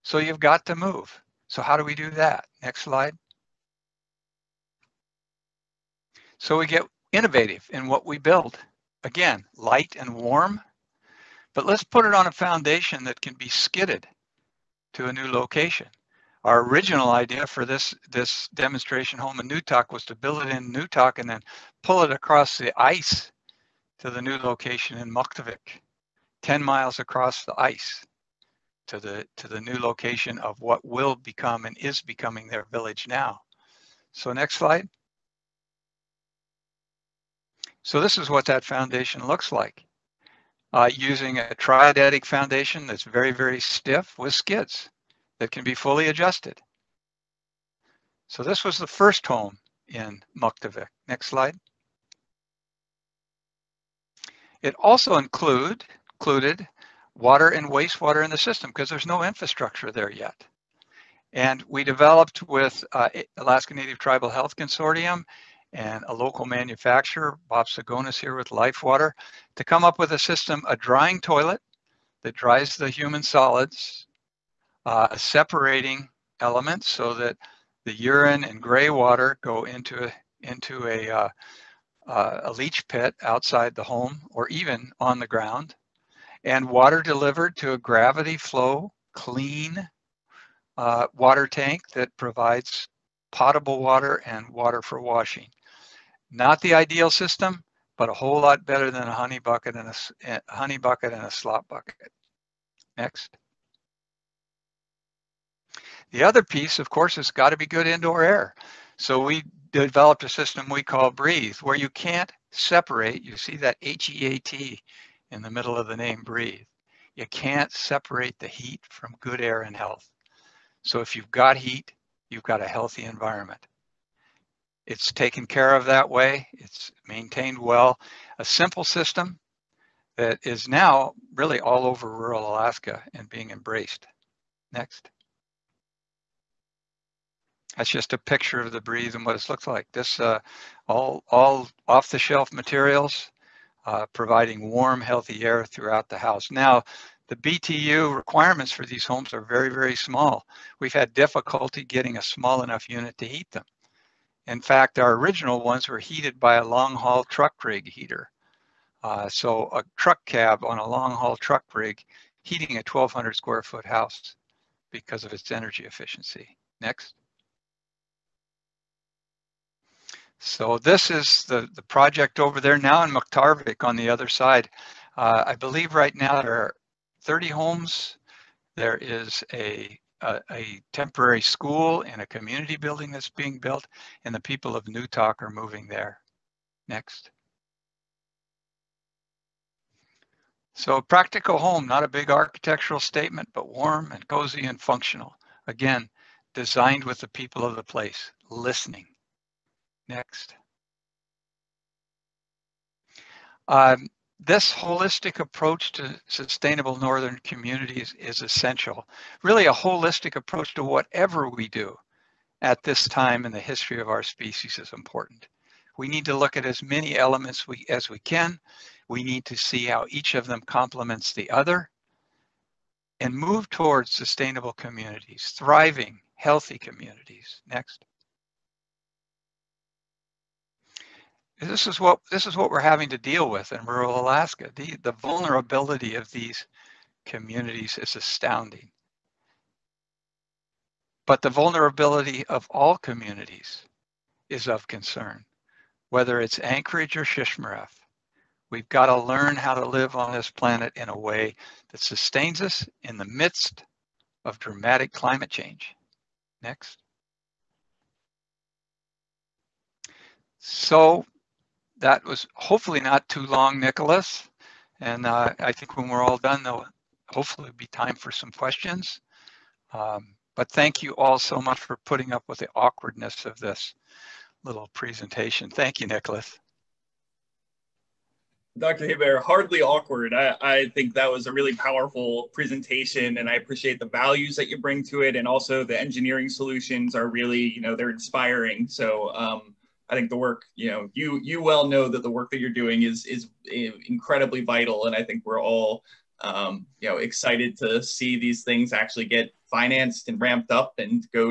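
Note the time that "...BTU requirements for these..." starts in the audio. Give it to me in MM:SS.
02:27.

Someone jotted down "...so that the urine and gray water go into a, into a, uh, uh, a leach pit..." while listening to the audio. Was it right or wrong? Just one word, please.
right.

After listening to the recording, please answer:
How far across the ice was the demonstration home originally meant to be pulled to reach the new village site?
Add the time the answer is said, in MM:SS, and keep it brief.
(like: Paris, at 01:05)
10 miles, at 00:26.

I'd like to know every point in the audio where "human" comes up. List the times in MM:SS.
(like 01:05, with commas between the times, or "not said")
01:12.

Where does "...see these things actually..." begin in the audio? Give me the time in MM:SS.
04:58.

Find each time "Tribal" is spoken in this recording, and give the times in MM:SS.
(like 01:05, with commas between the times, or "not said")
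01:03.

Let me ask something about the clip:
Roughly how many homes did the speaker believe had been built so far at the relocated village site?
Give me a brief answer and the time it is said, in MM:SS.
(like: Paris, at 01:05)
30, at 02:57.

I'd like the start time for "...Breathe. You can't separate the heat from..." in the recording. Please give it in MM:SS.
01:56.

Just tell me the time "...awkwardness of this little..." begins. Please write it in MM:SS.
04:32.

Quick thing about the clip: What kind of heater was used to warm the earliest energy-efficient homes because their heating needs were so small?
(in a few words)
long haul truck rig heater.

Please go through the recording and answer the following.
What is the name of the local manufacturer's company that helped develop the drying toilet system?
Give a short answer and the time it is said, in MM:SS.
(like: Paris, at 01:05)
Lifewater, at 01:08.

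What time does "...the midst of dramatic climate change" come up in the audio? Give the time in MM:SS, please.
04:13.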